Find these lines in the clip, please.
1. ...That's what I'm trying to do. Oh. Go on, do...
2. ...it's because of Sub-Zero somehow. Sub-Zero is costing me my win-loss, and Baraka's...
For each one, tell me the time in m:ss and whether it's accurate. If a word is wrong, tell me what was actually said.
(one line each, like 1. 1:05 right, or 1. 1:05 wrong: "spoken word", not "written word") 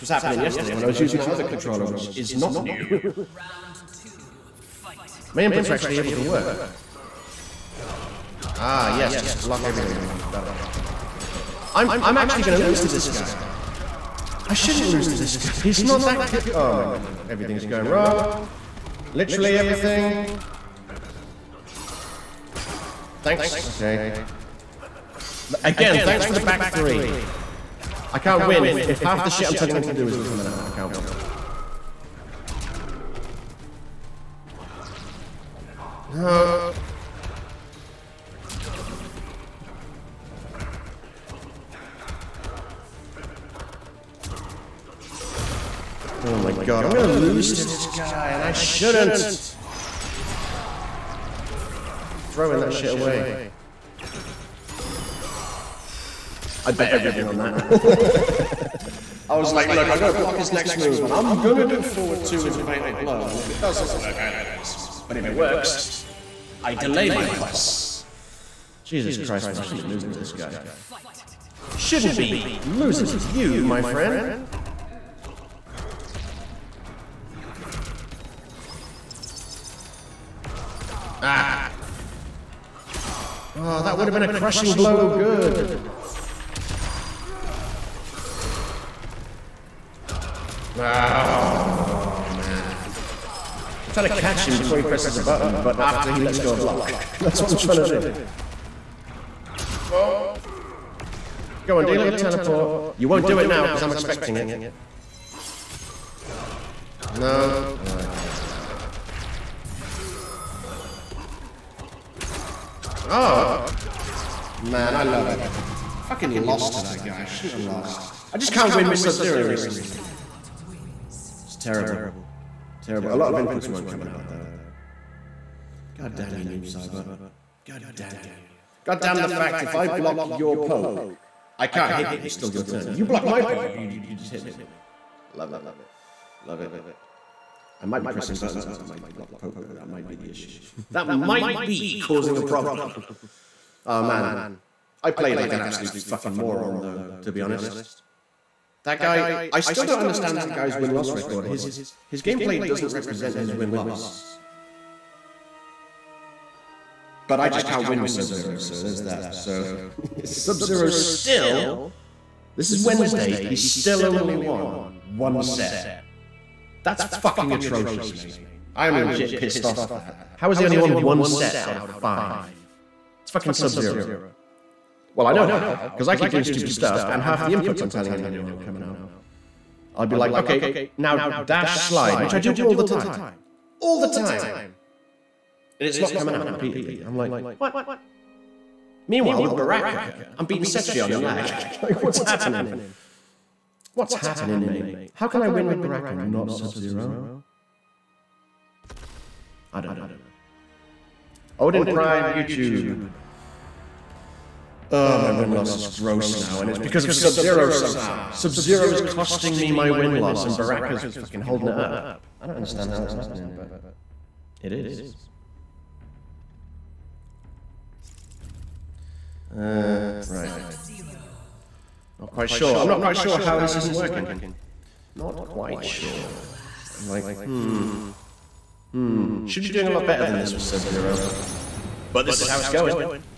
1. 1:37 right
2. 3:26 right.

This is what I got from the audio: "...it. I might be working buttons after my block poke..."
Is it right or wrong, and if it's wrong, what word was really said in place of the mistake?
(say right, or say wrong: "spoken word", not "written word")
wrong: "pressing", not "working".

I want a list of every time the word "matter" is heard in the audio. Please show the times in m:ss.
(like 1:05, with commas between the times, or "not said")
not said.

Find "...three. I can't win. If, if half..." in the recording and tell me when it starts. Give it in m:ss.
0:26.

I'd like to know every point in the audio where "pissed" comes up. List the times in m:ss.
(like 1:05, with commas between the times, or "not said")
2:49.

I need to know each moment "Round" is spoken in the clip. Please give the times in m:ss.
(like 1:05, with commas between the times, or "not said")
0:02.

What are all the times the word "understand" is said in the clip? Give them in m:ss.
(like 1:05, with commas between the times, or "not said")
2:29, 3:32.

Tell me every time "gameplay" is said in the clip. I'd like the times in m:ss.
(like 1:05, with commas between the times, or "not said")
2:32.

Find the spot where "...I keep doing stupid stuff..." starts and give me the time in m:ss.
2:56.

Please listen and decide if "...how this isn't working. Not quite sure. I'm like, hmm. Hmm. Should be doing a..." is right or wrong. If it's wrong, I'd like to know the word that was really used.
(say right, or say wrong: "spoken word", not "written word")
right.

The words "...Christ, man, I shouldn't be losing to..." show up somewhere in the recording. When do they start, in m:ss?
1:09.